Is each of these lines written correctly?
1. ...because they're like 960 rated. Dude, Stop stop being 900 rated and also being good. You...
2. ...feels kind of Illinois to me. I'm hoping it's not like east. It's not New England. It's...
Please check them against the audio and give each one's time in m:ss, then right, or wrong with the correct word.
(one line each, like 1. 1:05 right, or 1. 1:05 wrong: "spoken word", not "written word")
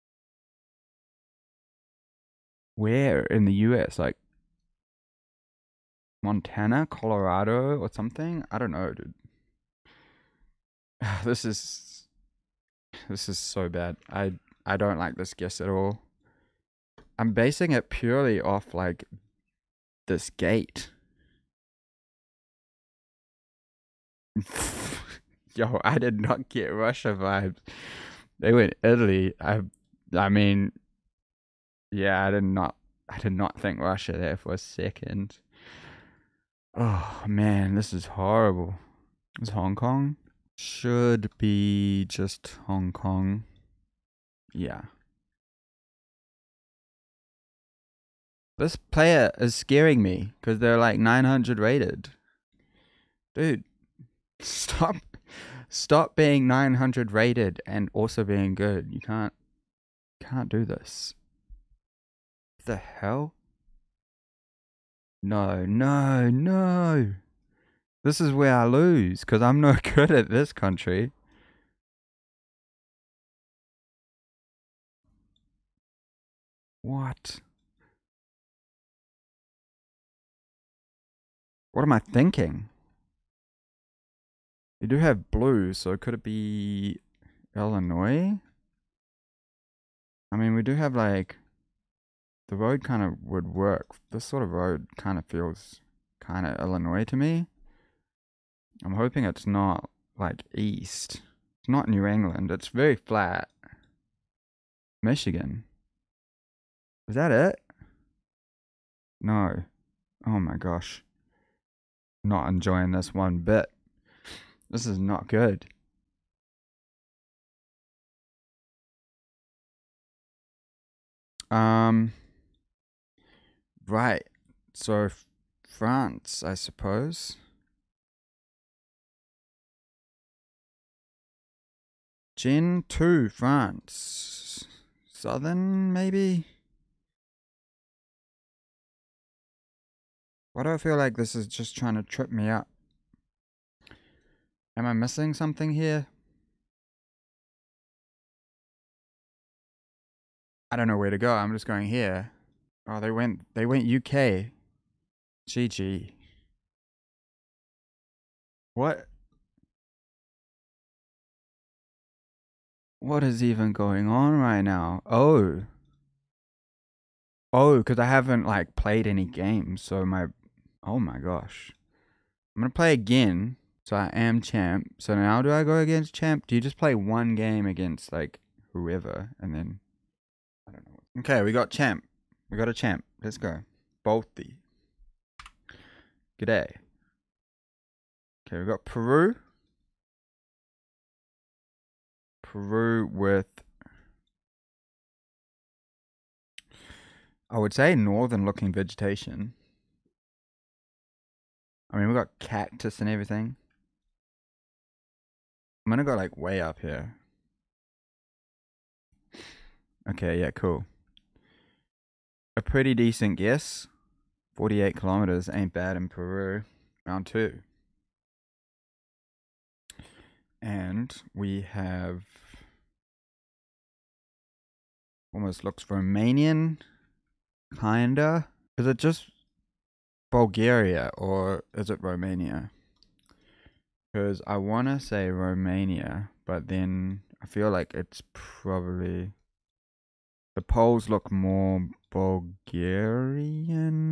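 1. 0:50 wrong: "900", not "960"
2. 1:35 right.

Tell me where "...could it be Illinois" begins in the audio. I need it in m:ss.
1:25.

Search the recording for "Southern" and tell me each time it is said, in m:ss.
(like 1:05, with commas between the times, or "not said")
2:15.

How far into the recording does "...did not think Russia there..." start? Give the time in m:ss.
0:33.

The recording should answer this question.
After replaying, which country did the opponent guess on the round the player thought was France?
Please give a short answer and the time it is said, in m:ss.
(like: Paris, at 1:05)
UK, at 2:33.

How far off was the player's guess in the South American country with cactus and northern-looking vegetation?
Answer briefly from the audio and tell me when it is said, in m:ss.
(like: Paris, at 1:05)
48 kilometers, at 3:34.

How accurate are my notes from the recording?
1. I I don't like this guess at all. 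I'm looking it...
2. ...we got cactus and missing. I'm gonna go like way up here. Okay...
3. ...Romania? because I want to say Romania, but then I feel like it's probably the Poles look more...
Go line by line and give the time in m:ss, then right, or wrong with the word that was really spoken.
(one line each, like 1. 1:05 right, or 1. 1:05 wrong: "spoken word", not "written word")
1. 0:14 wrong: "basing", not "looking"
2. 3:22 wrong: "everything", not "missing"
3. 3:52 right.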